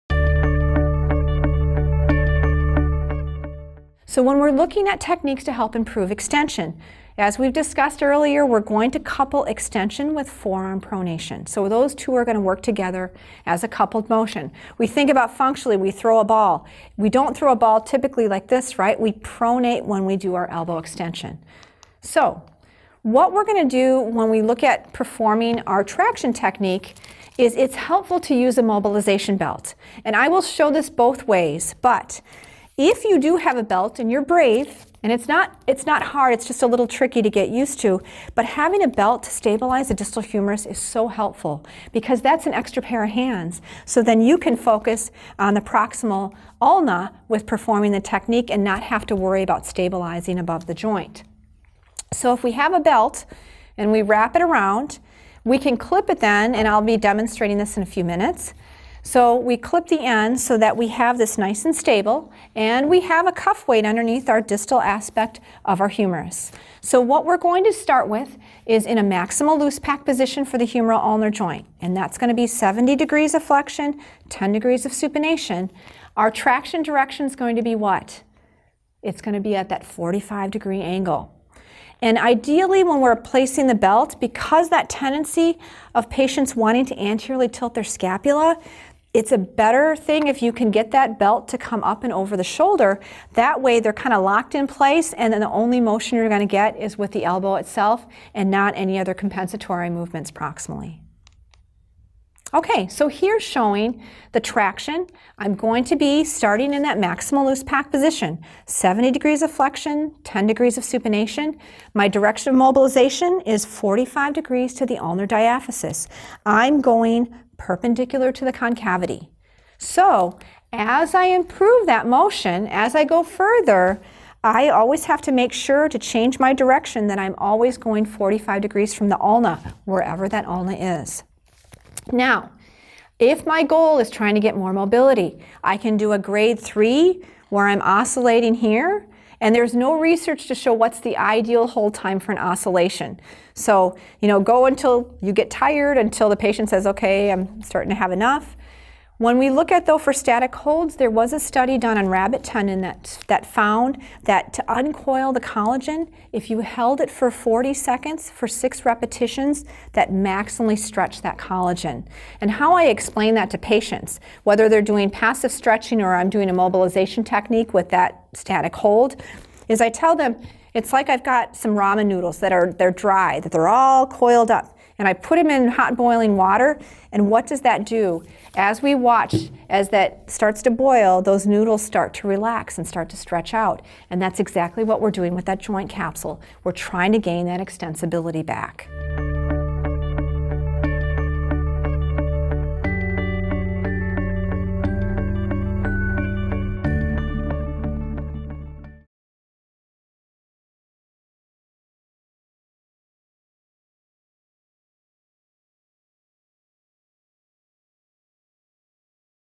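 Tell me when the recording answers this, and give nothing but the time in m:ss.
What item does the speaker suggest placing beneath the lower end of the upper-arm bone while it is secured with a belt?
1:03.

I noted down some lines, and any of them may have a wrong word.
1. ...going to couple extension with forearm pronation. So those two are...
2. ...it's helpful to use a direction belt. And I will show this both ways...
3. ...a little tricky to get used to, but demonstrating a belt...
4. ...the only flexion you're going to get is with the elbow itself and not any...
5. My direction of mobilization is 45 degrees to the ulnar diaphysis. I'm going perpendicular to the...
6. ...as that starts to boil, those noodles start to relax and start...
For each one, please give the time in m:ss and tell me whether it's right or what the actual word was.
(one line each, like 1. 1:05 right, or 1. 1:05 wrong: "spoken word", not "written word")
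1. 0:08 right
2. 0:27 wrong: "mobilization", not "direction"
3. 0:36 wrong: "having", not "demonstrating"
4. 1:35 wrong: "motion", not "flexion"
5. 1:51 right
6. 2:59 right.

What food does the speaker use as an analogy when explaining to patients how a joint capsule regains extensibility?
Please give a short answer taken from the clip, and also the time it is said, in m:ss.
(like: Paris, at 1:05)
Ramen noodles, at 2:51.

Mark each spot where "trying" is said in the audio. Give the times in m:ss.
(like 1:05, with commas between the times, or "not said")
2:14, 3:06.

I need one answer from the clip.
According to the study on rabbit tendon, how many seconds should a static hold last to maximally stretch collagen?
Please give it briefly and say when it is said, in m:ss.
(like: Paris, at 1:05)
40, at 2:37.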